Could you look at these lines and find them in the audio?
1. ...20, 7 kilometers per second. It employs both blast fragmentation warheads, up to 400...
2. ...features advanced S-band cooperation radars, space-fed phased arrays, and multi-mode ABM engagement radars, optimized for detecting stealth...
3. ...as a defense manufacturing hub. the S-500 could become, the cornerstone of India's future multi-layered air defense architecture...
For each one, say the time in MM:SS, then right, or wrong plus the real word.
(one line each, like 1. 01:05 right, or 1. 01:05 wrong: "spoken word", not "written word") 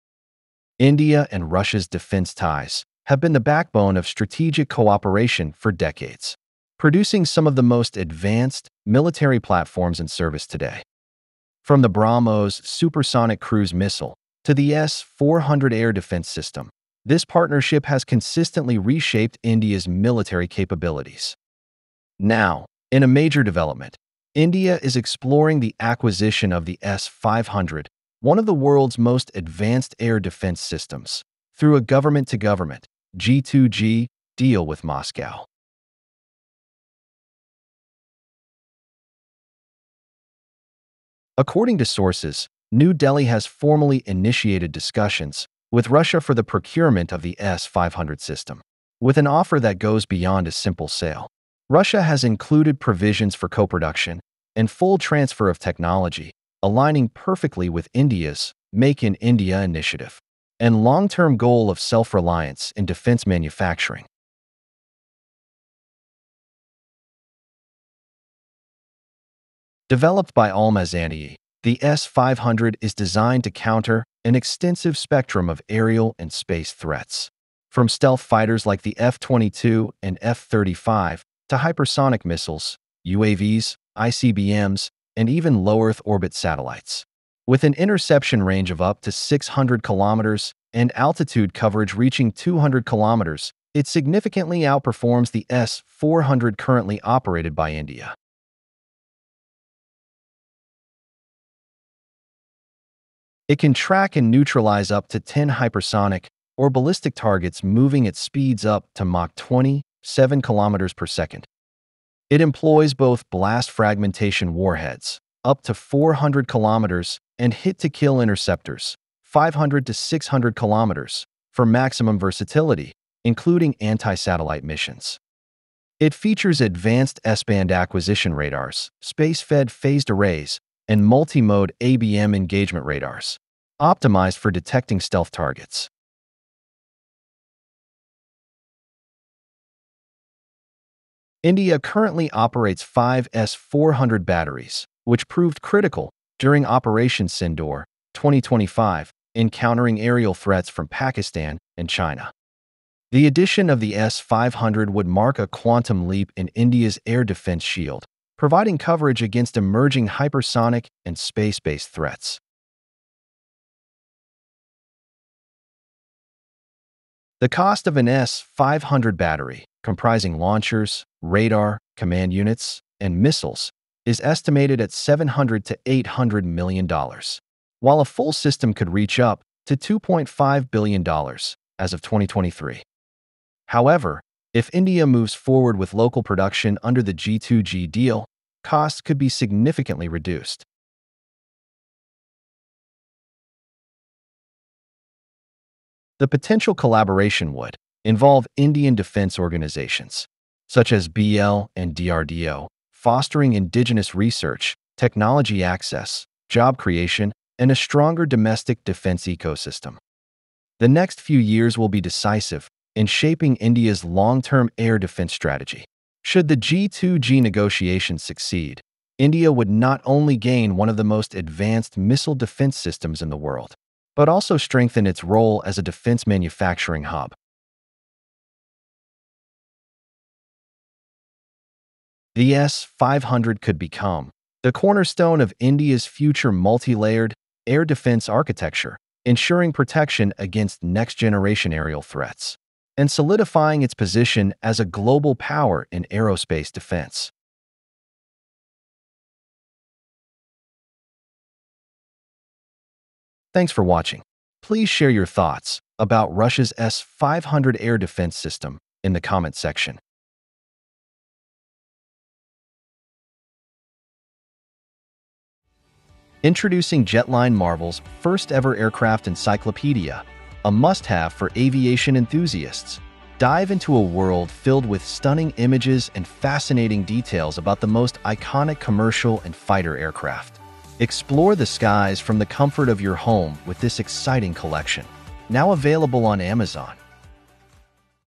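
1. 01:49 right
2. 02:06 wrong: "acquisition", not "cooperation"
3. 03:45 right.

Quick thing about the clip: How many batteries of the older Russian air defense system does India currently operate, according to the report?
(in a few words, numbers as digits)
5.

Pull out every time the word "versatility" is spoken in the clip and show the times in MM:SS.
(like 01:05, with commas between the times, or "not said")
02:02.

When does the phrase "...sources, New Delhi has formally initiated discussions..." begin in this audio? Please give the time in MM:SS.
00:41.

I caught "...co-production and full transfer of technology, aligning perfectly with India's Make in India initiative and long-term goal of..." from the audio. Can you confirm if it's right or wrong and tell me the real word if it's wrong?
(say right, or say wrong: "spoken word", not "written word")
right.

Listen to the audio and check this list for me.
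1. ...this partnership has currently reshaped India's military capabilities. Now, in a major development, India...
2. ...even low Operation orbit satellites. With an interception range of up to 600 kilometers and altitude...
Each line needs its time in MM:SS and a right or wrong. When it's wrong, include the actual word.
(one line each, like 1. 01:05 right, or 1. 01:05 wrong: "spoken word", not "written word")
1. 00:17 wrong: "consistently", not "currently"
2. 01:25 wrong: "Earth", not "Operation".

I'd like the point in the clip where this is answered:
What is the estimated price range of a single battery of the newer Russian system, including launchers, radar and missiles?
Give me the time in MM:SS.
02:54.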